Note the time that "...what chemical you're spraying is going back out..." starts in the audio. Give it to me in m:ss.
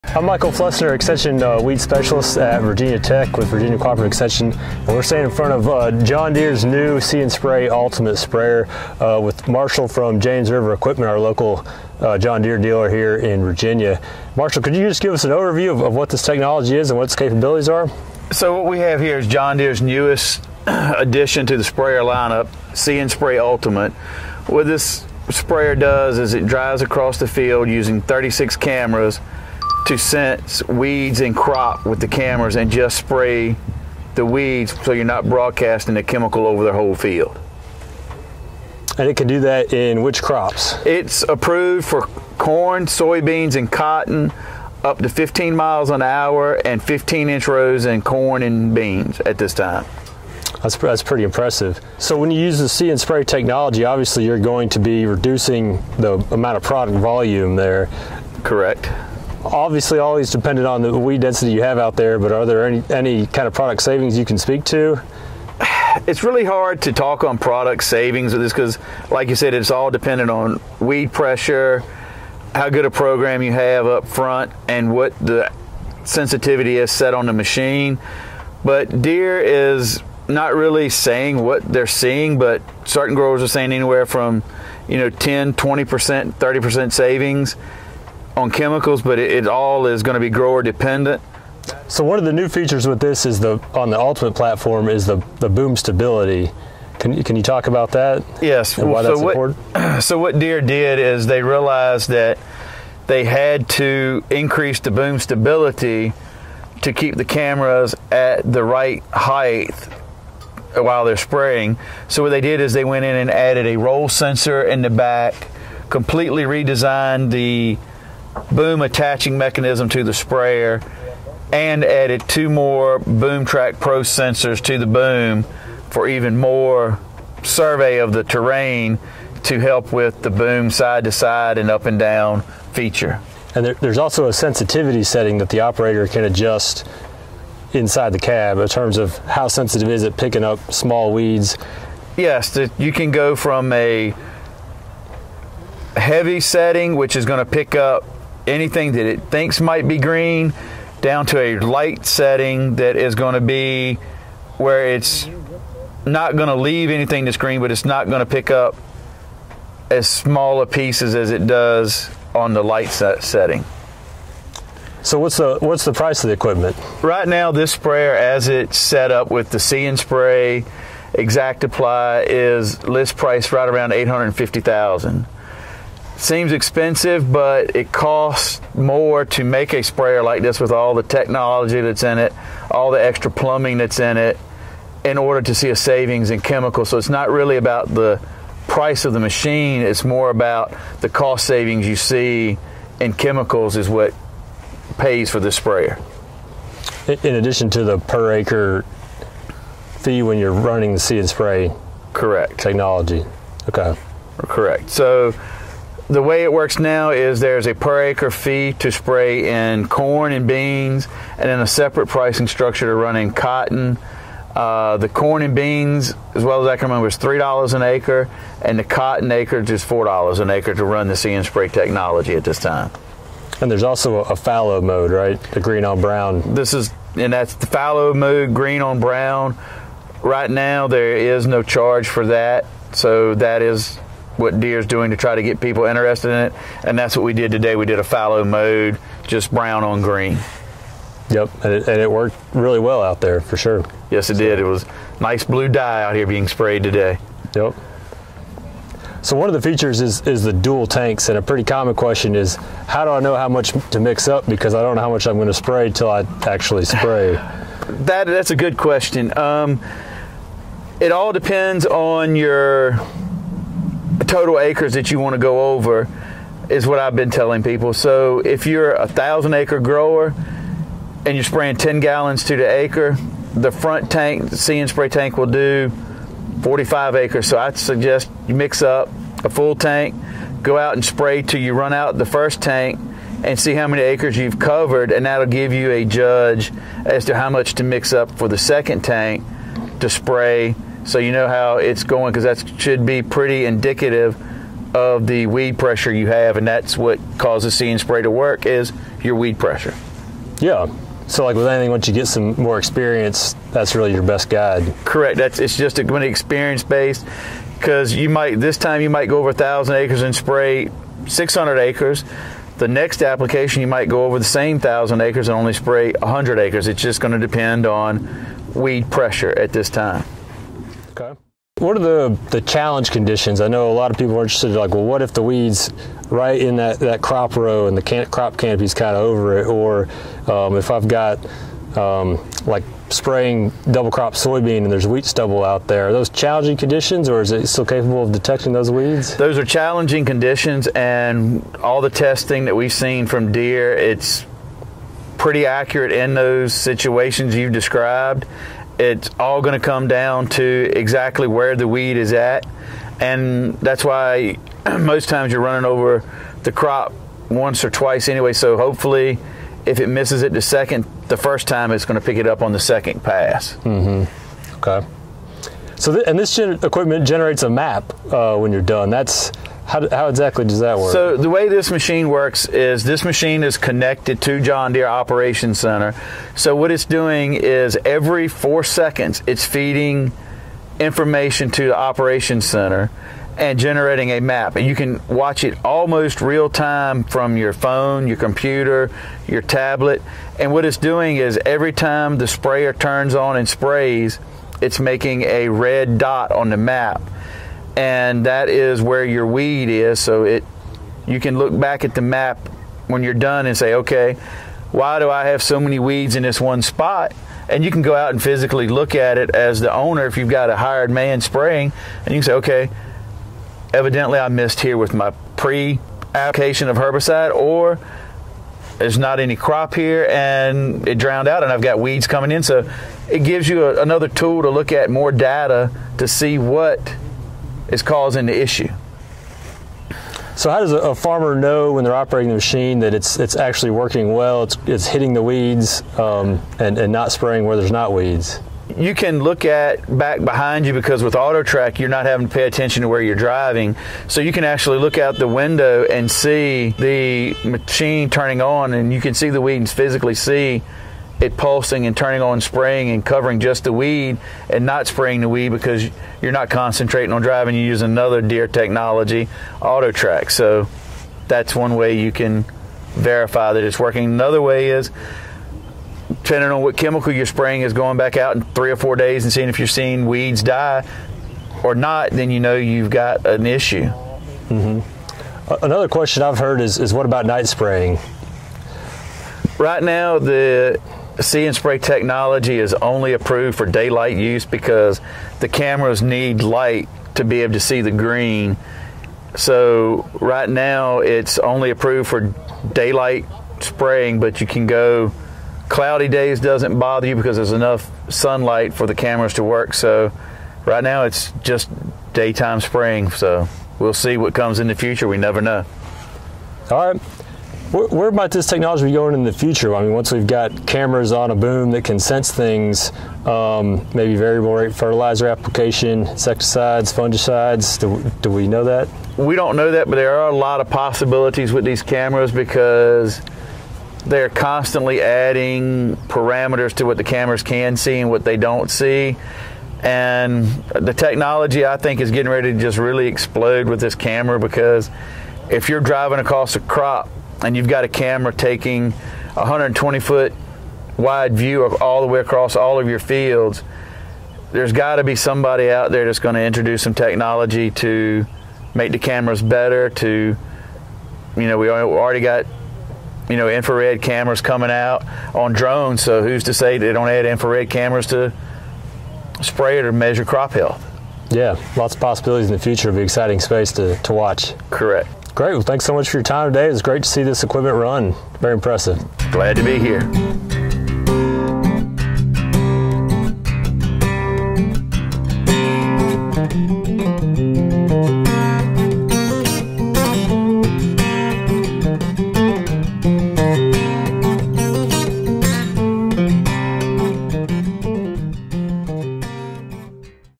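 7:46.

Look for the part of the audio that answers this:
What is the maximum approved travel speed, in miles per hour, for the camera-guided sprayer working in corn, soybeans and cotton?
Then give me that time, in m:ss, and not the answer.
0:45.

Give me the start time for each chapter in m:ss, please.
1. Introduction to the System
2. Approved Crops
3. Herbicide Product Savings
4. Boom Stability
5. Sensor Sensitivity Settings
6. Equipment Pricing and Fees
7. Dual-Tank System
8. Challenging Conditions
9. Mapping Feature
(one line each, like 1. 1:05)
1. 0:10
2. 0:39
3. 0:53
4. 1:33
5. 2:16
6. 2:45
7. 4:08
8. 5:24
9. 6:06.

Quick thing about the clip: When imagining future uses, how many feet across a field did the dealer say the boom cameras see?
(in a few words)
120 feet.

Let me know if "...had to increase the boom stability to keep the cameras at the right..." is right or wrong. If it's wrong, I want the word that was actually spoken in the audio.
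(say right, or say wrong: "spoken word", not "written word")
right.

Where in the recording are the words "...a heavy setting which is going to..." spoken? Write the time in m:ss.
2:23.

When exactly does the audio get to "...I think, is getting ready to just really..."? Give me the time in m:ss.
8:51.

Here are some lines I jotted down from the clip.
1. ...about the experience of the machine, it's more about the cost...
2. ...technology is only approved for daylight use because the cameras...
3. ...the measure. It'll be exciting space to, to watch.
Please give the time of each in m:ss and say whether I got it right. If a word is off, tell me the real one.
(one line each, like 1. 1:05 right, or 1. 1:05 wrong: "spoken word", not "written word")
1. 3:07 wrong: "price", not "experience"
2. 8:01 right
3. 9:22 wrong: "future", not "measure".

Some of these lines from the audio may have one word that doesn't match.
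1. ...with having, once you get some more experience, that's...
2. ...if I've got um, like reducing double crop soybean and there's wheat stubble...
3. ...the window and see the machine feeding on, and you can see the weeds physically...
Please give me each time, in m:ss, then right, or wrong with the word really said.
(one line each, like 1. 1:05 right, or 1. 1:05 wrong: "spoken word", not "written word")
1. 5:01 wrong: "anything", not "having"
2. 5:30 wrong: "spraying", not "reducing"
3. 7:25 wrong: "turning", not "feeding".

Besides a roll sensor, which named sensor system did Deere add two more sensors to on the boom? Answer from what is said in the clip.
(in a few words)
BoomTrac Pro.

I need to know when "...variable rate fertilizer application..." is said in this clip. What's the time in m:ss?
8:34.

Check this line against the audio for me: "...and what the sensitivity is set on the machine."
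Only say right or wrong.
right.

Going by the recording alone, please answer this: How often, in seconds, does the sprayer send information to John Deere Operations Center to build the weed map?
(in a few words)
Every 4 seconds.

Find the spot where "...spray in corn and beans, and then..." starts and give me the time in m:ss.
3:28.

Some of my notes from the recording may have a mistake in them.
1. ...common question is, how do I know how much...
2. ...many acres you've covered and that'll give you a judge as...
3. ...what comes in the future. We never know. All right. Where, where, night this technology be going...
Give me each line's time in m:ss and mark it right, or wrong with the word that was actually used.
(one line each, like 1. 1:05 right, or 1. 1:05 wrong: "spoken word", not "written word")
1. 4:11 right
2. 4:43 right
3. 8:24 wrong: "might", not "night".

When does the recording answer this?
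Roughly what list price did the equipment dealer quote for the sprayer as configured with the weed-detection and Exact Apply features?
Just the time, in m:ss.
2:53.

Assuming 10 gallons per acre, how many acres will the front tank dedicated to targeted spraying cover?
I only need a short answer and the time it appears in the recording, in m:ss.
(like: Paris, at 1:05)
45 acres, at 4:36.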